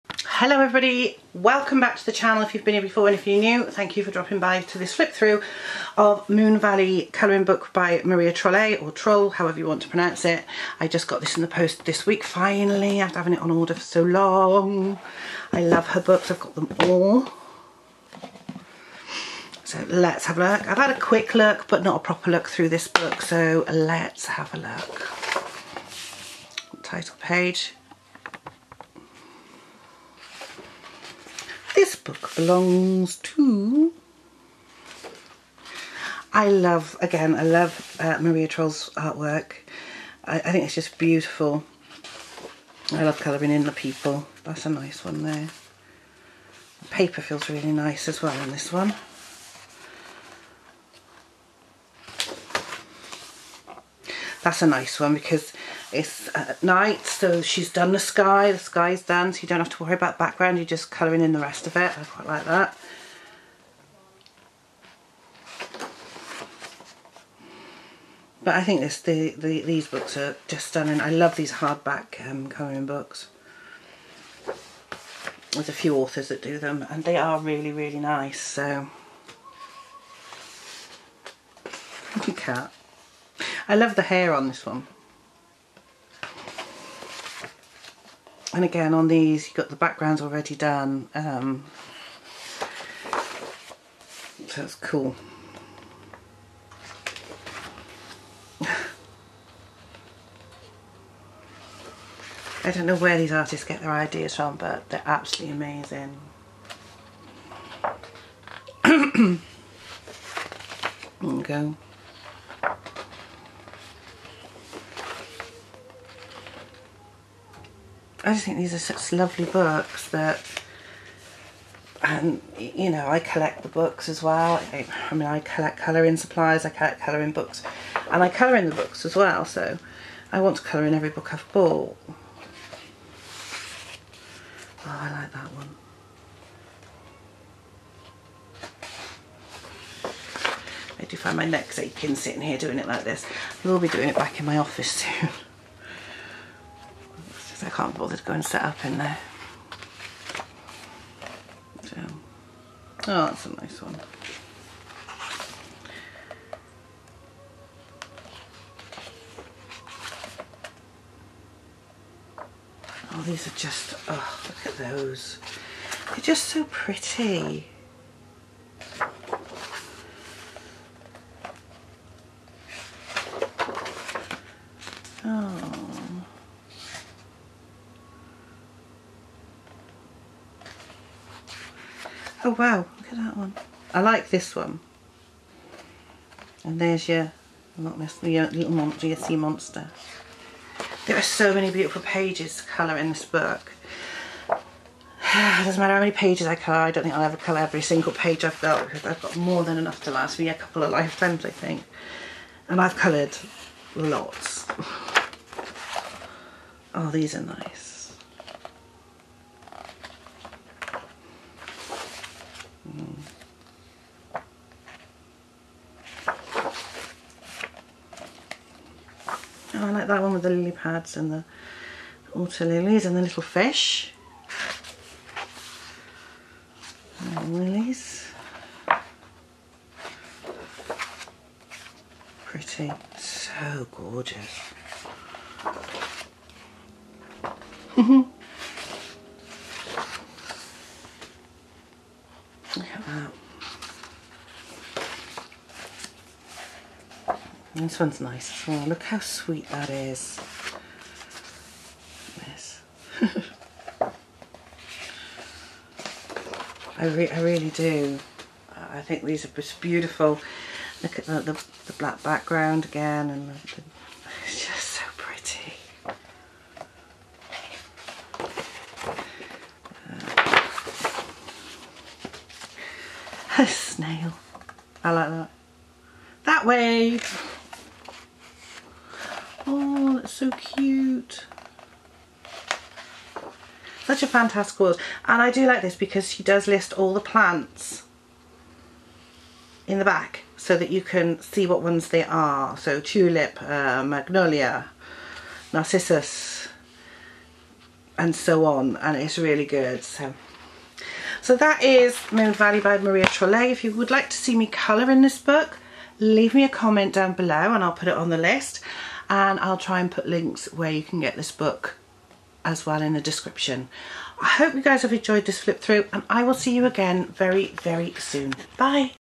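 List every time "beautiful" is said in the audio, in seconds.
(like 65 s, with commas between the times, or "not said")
40 s, 191 s, 259 s.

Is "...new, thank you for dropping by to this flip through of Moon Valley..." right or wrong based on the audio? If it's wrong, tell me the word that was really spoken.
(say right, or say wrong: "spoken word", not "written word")
right.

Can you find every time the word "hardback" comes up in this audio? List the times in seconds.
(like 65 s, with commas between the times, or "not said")
71 s.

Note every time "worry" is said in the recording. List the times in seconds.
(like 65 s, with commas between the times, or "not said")
59 s.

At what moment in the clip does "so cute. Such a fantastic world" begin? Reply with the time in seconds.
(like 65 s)
280 s.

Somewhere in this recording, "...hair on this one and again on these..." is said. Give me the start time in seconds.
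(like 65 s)
84 s.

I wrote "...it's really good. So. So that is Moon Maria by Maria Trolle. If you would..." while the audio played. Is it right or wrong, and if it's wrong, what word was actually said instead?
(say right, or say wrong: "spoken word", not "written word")
wrong: "Valley", not "Maria".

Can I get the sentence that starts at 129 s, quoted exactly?
So I want to colour in every book I've bought.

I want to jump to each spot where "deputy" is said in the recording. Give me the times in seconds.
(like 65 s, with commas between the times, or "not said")
not said.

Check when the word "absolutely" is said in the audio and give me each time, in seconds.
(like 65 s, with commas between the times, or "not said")
105 s.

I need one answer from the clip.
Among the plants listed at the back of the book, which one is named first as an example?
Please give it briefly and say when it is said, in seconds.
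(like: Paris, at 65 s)
tulip, at 293 s.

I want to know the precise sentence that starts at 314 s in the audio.
I hope you guys have enjoyed this flip through and I will see you again very, very soon.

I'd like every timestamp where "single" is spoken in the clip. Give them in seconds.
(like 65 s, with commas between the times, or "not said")
197 s.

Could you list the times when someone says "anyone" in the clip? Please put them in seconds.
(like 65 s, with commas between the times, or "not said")
not said.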